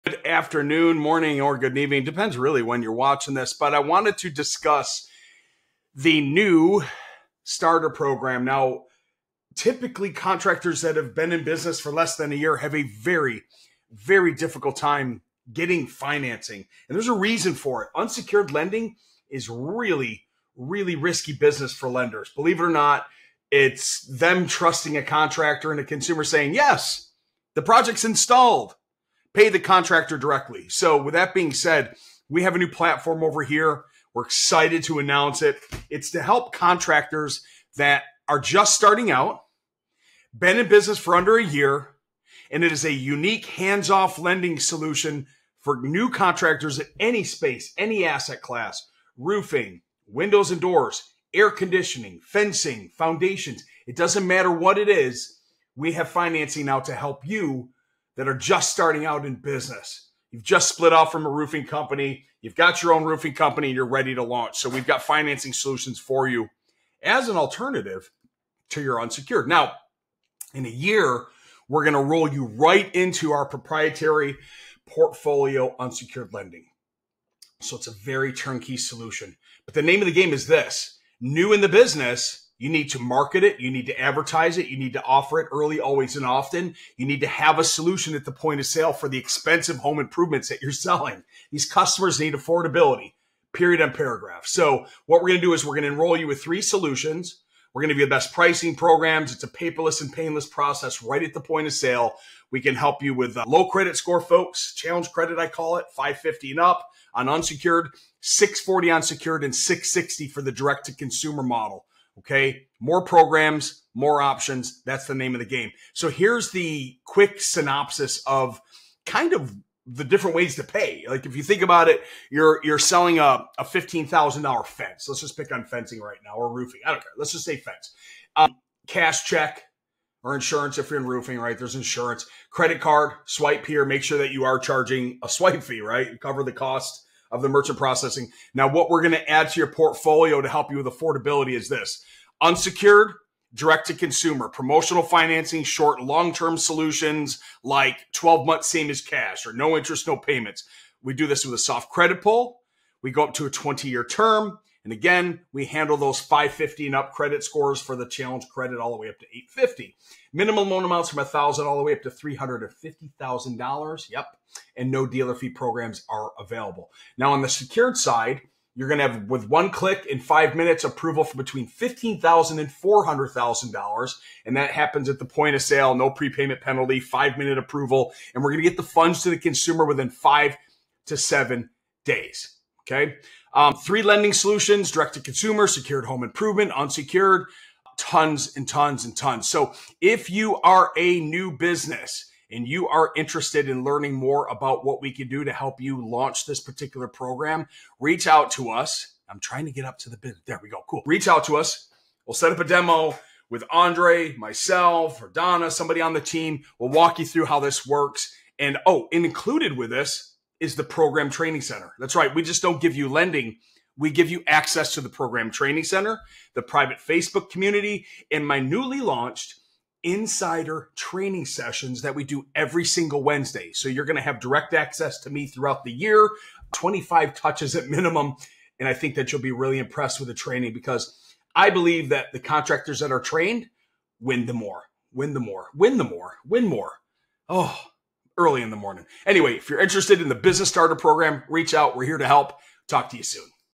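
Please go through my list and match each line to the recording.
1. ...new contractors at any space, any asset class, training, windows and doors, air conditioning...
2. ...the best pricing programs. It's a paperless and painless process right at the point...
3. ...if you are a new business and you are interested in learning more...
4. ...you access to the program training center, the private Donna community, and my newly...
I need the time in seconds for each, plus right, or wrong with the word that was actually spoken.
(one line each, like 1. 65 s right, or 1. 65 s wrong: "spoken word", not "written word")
1. 45 s wrong: "roofing", not "training"
2. 98 s right
3. 189 s right
4. 214 s wrong: "Facebook", not "Donna".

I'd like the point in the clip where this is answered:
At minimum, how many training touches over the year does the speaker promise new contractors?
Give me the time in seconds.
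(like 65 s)
226 s.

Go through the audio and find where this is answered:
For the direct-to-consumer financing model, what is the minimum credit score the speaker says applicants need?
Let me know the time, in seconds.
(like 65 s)
109 s.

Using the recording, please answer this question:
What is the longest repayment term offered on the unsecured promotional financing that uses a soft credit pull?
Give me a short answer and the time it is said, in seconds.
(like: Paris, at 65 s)
20 years, at 153 s.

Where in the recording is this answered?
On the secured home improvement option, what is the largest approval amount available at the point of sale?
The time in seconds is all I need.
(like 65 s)
172 s.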